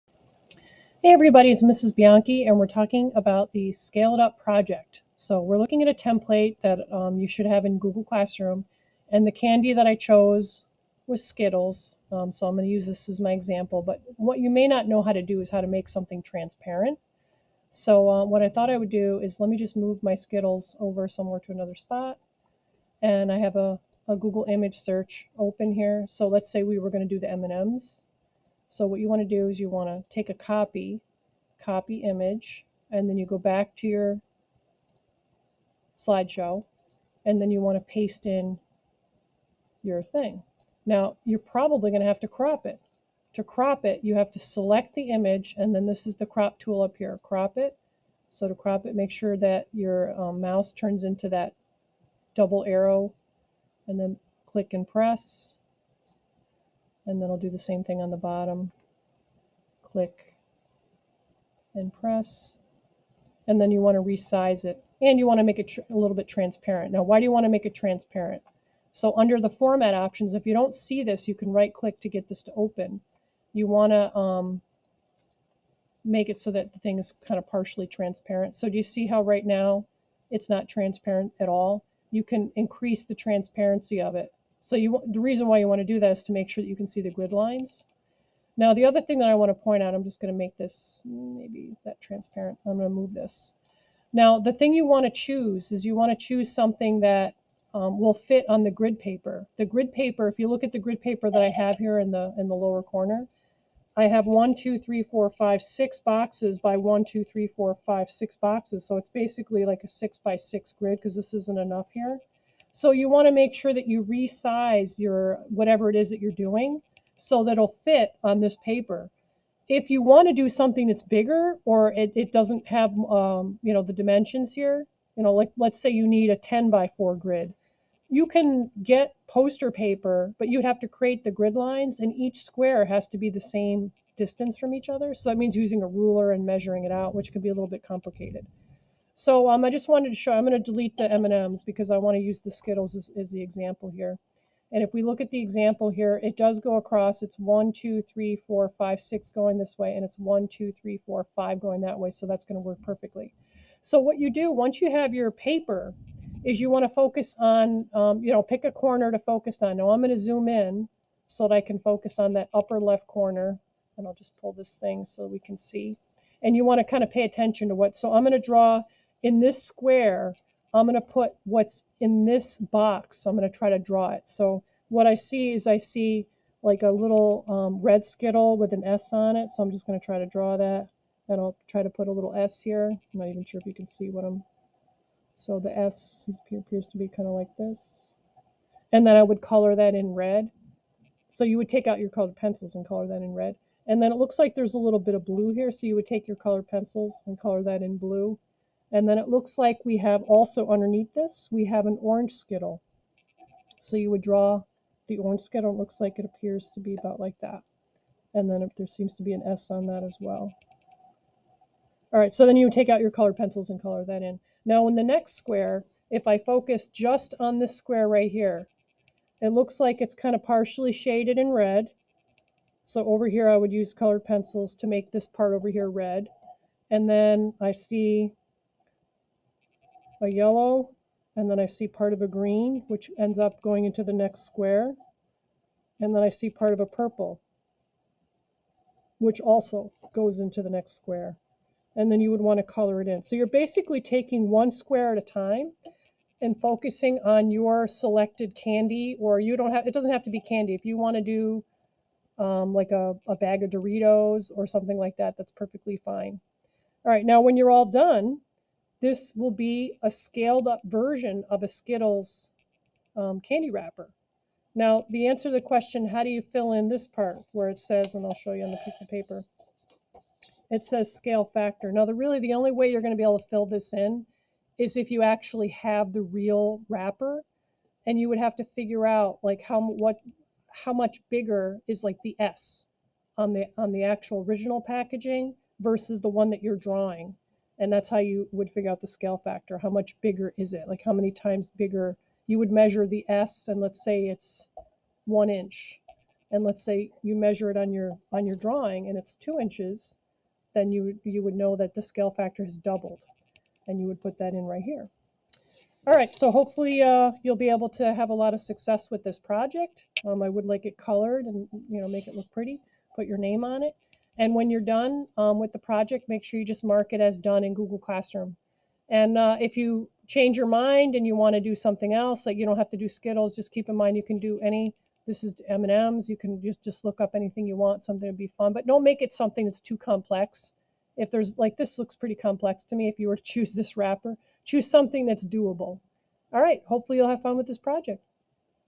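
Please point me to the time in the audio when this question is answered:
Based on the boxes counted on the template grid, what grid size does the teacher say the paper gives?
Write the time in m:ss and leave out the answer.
1:49.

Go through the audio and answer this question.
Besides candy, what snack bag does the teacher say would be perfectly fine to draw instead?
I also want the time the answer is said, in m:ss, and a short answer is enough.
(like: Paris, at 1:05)
Doritos, at 4:13.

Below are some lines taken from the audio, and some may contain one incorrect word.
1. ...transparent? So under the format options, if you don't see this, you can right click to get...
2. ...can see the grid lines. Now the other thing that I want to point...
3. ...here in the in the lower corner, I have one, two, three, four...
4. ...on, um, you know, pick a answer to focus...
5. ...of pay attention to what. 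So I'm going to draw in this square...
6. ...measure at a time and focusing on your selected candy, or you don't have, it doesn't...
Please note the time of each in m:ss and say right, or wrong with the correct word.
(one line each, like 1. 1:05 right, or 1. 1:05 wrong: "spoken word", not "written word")
1. 1:07 right
2. 1:26 right
3. 1:41 right
4. 2:37 wrong: "corner", not "answer"
5. 2:47 right
6. 4:04 wrong: "square", not "measure".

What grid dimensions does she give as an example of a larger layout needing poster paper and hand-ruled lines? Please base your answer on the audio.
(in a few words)
10 by 4.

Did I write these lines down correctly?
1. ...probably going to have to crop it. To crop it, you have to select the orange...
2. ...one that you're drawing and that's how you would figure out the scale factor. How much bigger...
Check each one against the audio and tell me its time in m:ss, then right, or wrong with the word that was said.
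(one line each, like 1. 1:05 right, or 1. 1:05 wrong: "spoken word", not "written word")
1. 0:41 wrong: "image", not "orange"
2. 4:46 right.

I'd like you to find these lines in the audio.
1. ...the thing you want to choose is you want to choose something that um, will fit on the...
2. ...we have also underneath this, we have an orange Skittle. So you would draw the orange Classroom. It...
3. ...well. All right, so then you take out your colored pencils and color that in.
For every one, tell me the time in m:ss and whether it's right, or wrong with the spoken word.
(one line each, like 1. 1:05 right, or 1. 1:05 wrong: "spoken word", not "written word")
1. 1:34 right
2. 3:19 wrong: "Skittle", not "Classroom"
3. 3:30 right.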